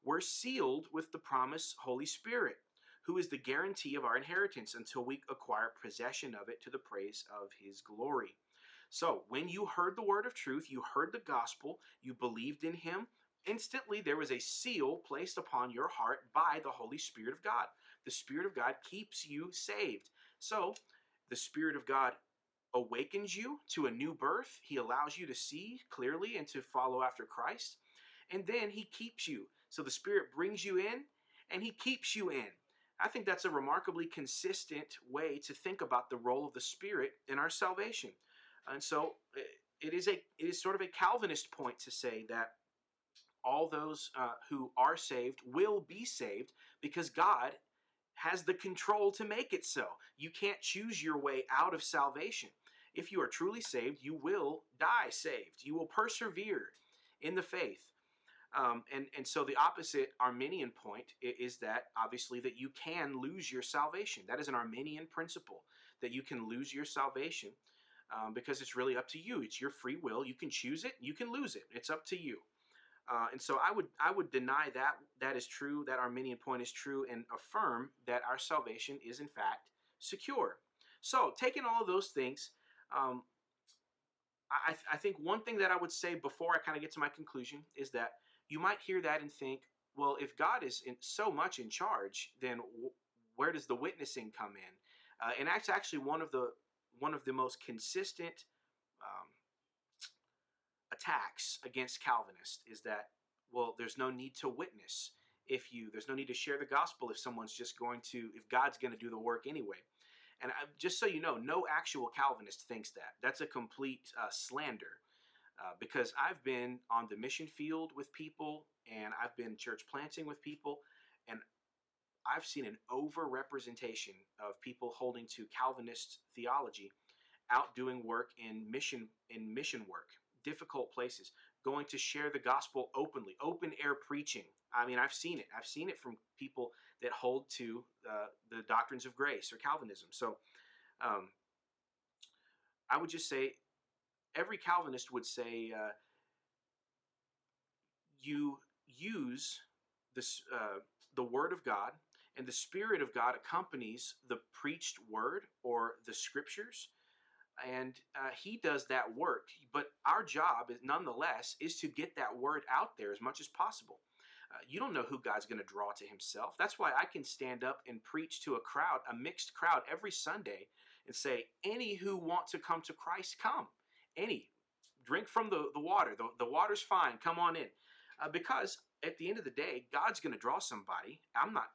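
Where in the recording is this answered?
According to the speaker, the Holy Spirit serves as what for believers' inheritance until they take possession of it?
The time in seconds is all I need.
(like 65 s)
3 s.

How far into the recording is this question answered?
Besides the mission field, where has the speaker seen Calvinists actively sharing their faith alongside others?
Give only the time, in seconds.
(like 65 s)
119 s.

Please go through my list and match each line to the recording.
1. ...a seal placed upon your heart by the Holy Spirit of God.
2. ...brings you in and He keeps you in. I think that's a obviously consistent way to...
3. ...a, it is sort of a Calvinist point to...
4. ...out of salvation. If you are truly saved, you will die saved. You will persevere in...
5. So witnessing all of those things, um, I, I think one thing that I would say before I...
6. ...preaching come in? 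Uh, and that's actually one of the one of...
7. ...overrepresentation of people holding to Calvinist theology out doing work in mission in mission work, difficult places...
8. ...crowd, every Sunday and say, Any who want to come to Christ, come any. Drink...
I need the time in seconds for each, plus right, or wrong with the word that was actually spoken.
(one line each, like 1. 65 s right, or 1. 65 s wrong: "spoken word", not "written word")
1. 14 s right
2. 30 s wrong: "remarkably", not "obviously"
3. 40 s right
4. 51 s right
5. 81 s wrong: "taking", not "witnessing"
6. 93 s wrong: "witnessing", not "preaching"
7. 122 s right
8. 169 s right.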